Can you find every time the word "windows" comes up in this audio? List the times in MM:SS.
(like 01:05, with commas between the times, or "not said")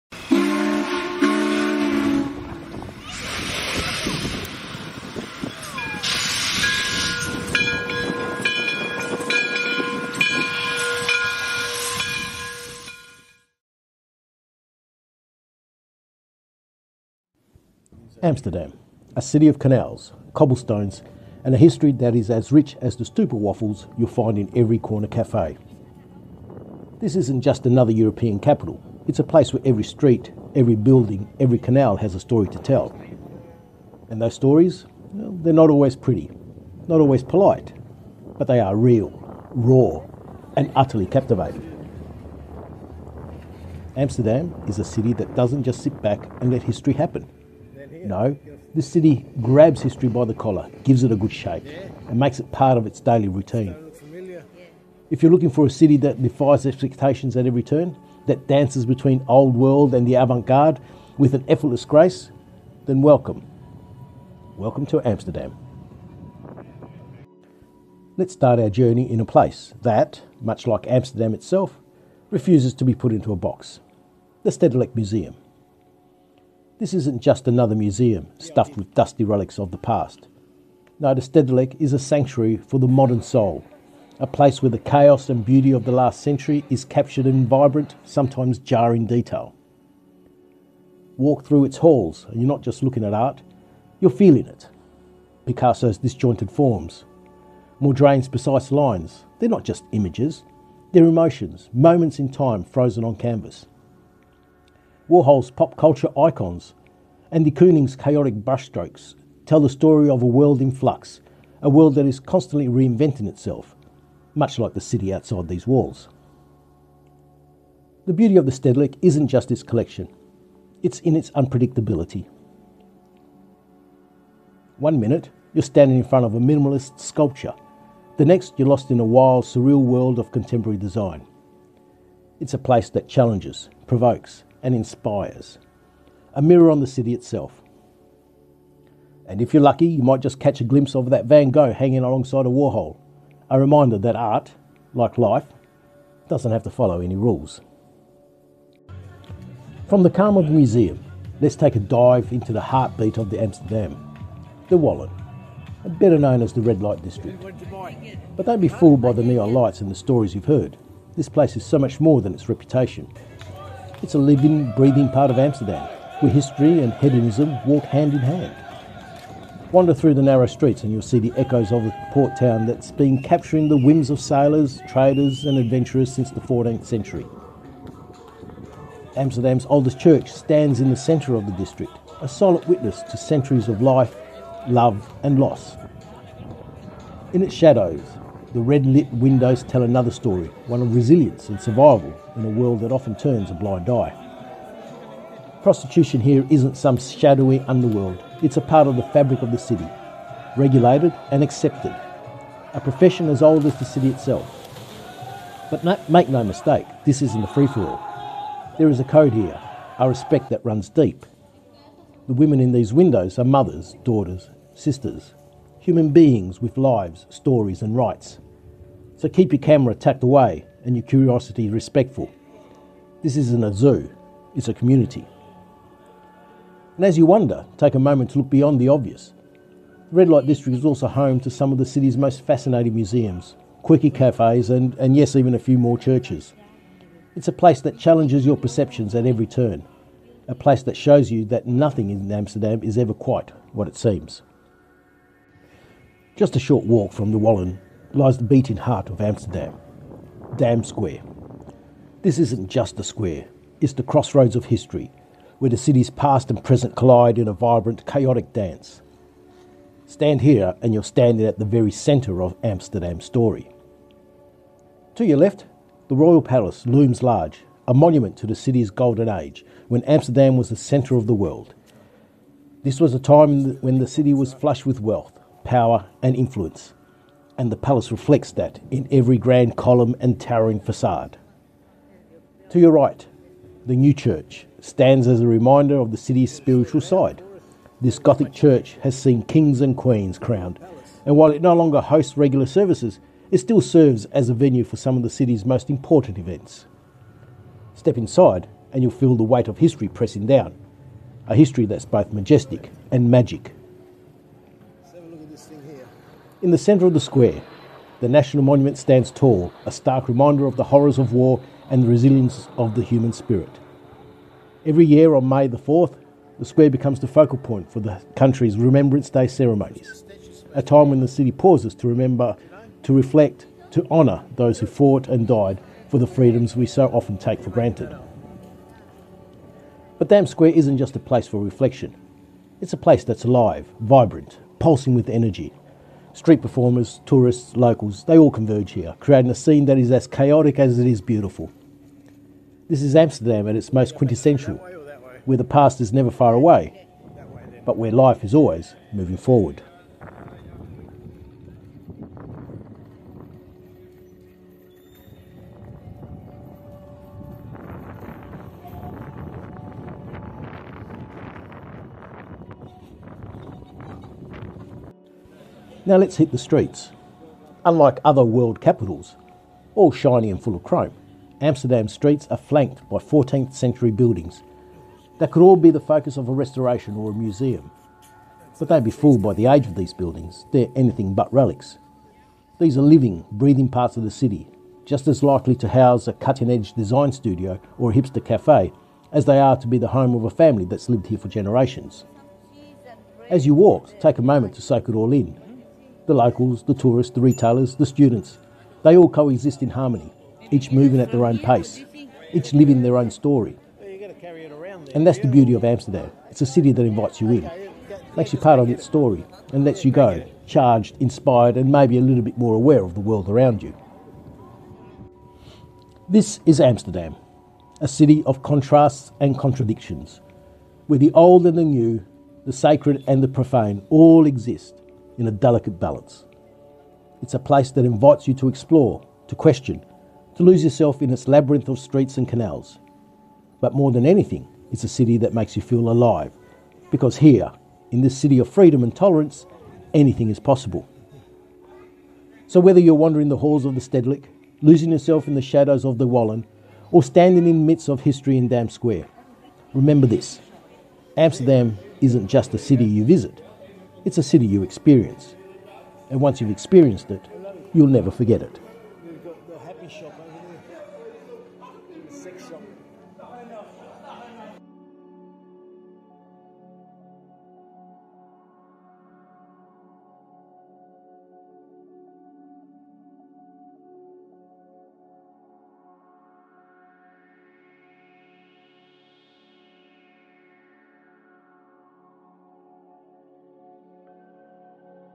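03:09, 03:32.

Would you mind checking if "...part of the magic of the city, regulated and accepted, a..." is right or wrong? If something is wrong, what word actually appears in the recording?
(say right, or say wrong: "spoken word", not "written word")
wrong: "fabric", not "magic".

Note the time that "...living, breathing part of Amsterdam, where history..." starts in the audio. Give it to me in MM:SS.
02:44.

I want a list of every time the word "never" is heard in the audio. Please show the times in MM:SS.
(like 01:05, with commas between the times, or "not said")
05:46, 07:38.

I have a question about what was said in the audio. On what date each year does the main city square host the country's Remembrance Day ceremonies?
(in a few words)
May 4.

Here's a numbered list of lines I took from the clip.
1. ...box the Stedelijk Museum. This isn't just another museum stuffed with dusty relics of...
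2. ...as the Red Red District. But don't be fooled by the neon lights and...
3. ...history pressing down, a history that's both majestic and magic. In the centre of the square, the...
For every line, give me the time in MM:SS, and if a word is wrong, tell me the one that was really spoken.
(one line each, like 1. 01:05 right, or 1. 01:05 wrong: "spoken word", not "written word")
1. 01:13 right
2. 02:36 wrong: "Light", not "Red"
3. 04:59 right.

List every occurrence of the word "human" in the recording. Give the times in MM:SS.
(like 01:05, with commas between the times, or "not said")
03:35, 05:13.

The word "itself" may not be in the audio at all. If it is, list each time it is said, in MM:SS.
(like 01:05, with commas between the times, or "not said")
01:11, 01:53, 02:17, 03:24.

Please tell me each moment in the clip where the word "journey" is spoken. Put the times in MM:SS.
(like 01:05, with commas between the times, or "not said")
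01:08.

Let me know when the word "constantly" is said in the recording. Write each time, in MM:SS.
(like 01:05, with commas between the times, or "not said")
01:52.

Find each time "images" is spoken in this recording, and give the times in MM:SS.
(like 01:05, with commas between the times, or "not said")
01:39.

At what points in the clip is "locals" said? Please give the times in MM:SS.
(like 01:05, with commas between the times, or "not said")
05:37, 06:36.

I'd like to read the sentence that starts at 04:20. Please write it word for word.
Stand here and you're standing at the very centre of Amsterdam's story.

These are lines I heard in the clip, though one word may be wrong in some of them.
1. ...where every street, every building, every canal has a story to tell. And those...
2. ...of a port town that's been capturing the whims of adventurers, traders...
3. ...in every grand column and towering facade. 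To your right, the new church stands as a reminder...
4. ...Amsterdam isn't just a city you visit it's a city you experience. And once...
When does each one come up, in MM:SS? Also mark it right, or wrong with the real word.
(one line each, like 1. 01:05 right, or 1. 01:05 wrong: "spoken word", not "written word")
1. 00:29 right
2. 02:51 wrong: "sailors", not "adventurers"
3. 04:38 right
4. 07:31 right.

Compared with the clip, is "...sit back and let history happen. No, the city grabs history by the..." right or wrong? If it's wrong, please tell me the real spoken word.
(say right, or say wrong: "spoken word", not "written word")
right.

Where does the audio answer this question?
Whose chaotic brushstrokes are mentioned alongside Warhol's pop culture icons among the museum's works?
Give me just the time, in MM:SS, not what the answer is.
01:47.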